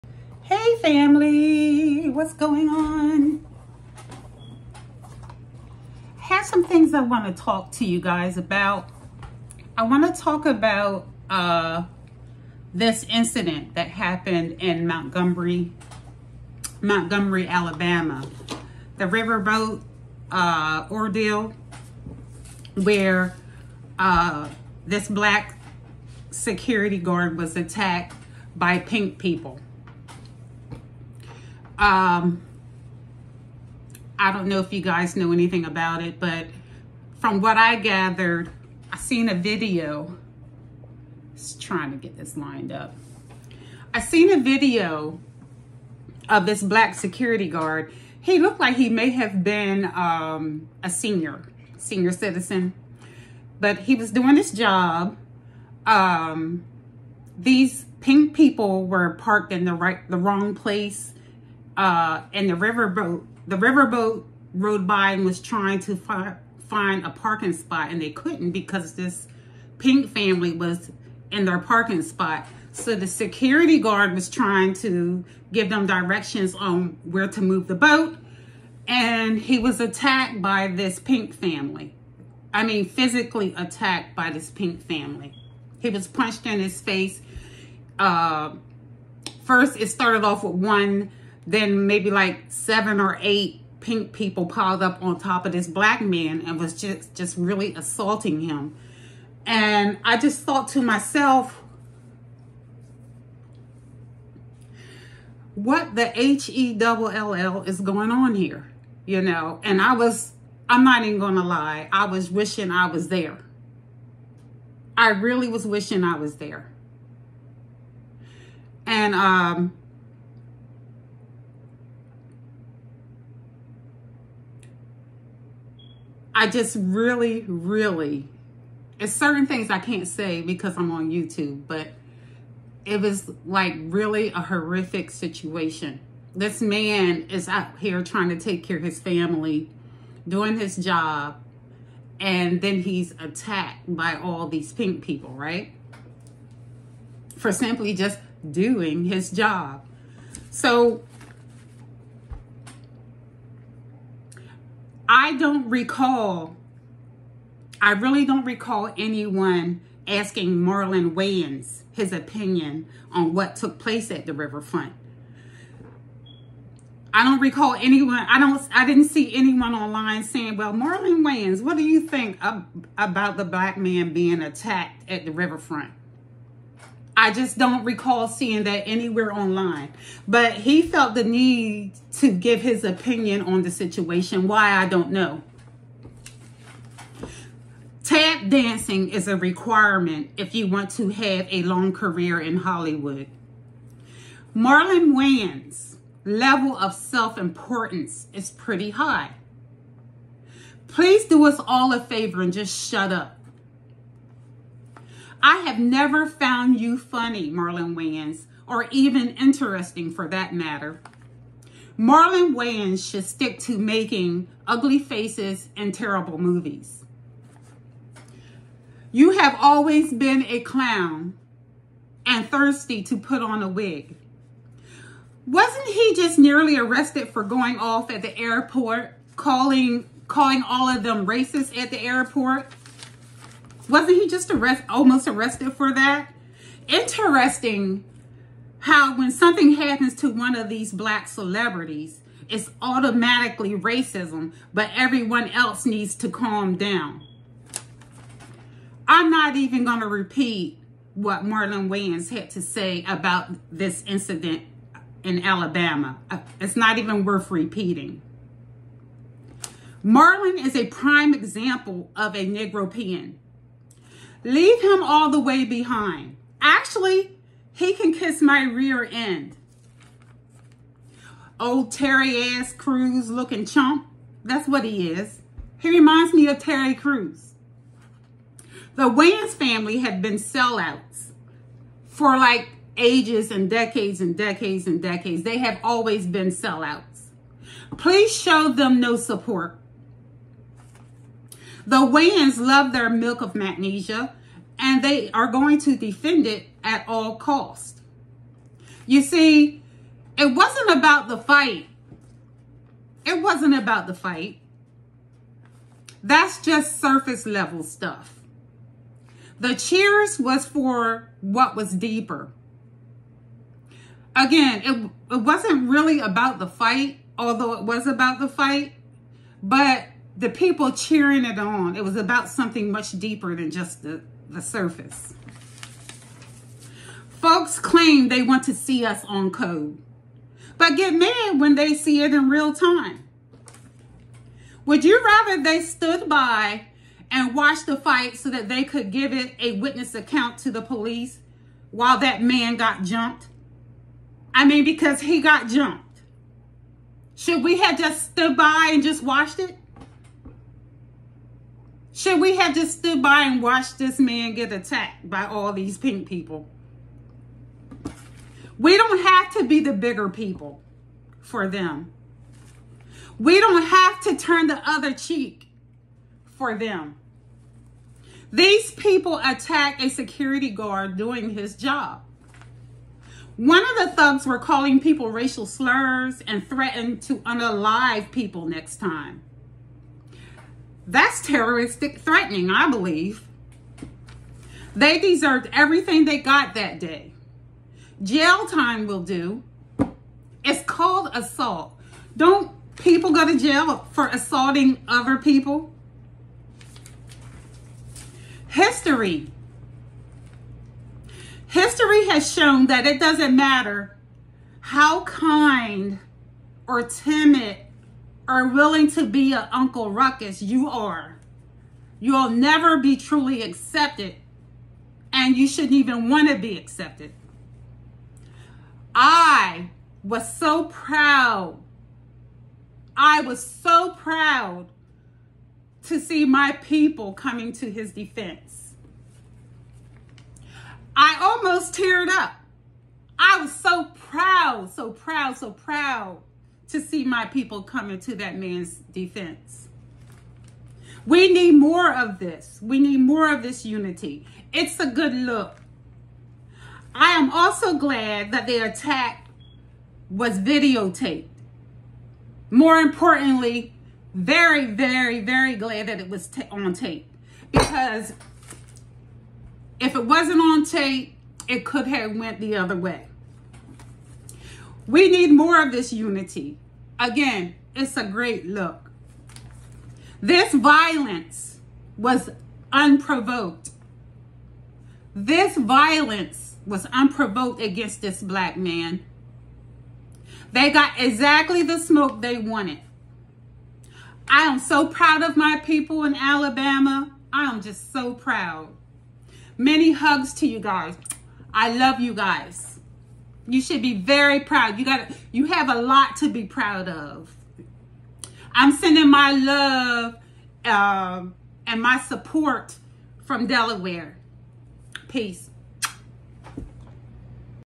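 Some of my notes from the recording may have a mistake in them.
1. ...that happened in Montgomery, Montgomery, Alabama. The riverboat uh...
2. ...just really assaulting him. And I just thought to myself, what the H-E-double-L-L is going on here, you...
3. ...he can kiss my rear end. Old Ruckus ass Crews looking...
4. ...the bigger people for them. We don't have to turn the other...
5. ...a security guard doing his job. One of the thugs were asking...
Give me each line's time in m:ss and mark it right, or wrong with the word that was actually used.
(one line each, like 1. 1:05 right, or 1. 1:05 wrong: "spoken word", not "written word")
1. 0:13 right
2. 1:37 right
3. 4:27 wrong: "Terry", not "Ruckus"
4. 5:59 right
5. 6:09 wrong: "calling", not "asking".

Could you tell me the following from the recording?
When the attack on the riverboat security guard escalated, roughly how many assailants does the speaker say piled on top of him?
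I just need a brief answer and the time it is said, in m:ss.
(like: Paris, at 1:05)
7 or 8, at 1:32.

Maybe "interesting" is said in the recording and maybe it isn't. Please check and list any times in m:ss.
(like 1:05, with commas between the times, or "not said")
3:29, 3:56.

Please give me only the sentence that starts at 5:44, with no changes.
I mean, because he got jumped.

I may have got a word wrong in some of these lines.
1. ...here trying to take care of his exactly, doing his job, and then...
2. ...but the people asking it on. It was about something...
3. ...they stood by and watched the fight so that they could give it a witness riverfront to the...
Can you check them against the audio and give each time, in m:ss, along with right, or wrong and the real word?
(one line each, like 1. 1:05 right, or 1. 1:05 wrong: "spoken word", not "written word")
1. 2:17 wrong: "family", not "exactly"
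2. 5:19 wrong: "cheering", not "asking"
3. 5:35 wrong: "account", not "riverfront".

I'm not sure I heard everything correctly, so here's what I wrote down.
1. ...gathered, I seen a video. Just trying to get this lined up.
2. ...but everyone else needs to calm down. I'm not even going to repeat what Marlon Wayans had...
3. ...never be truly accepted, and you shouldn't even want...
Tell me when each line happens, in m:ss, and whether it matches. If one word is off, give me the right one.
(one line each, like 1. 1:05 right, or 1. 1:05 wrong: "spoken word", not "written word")
1. 0:37 right
2. 4:04 right
3. 6:52 right.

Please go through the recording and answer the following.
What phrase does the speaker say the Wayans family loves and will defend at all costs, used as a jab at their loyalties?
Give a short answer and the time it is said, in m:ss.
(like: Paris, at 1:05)
milk of magnesia, at 4:53.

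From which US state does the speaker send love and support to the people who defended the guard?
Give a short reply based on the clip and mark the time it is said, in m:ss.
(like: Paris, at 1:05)
Delaware, at 8:23.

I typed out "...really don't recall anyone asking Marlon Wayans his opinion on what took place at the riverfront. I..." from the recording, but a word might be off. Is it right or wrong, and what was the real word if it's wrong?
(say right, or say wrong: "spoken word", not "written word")
right.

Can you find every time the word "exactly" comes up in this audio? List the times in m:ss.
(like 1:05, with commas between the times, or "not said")
8:01.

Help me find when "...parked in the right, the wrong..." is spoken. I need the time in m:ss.
0:59.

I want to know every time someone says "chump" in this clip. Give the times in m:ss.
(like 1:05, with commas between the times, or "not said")
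4:33.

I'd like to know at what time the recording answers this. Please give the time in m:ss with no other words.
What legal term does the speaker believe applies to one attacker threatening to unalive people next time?
6:21.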